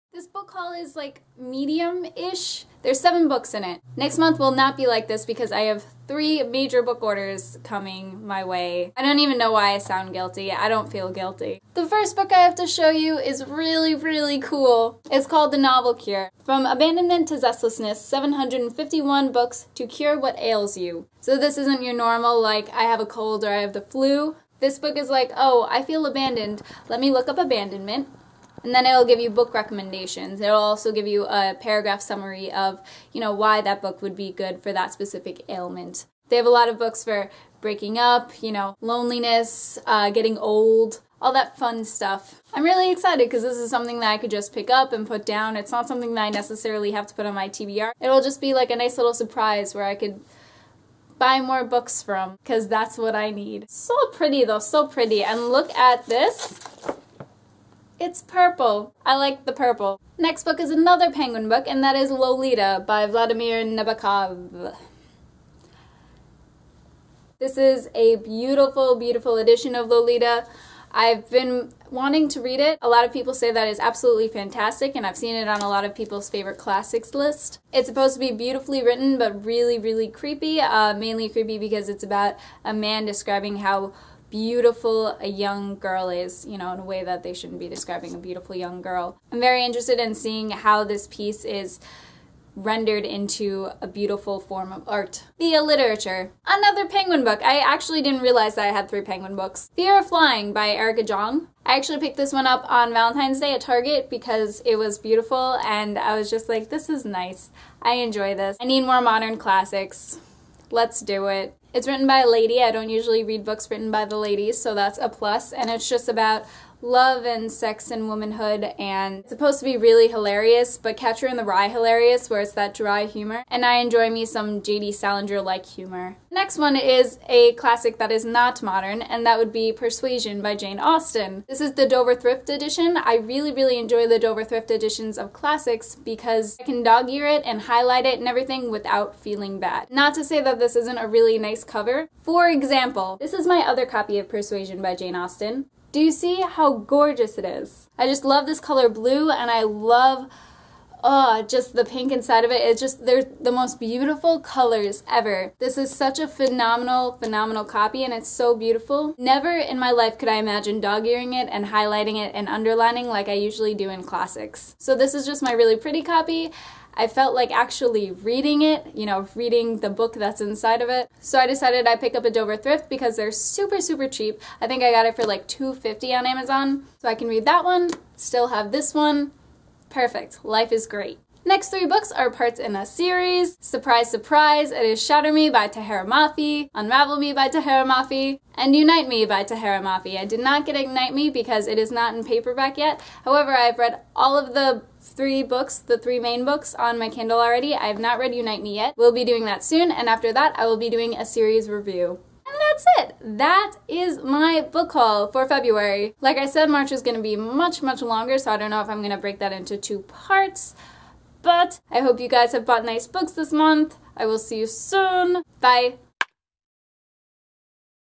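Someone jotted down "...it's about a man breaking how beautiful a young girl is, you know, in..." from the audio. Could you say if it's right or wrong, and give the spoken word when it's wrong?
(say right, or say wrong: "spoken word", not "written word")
wrong: "describing", not "breaking".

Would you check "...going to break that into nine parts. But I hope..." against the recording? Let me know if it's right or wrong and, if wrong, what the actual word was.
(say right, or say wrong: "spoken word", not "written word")
wrong: "two", not "nine".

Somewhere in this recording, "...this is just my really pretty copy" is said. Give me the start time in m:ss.
2:44.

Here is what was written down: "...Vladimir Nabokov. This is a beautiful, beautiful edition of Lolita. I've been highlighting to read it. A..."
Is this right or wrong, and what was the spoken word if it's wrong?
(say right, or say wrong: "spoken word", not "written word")
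wrong: "wanting", not "highlighting".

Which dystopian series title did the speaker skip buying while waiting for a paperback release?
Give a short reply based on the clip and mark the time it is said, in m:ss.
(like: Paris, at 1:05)
Ignite Me, at 3:10.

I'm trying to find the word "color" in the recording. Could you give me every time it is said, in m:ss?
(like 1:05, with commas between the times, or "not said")
2:28, 2:34.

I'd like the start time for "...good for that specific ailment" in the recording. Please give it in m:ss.
0:34.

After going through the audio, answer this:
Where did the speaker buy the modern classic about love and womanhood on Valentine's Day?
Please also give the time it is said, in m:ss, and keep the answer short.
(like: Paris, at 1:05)
Target, at 1:43.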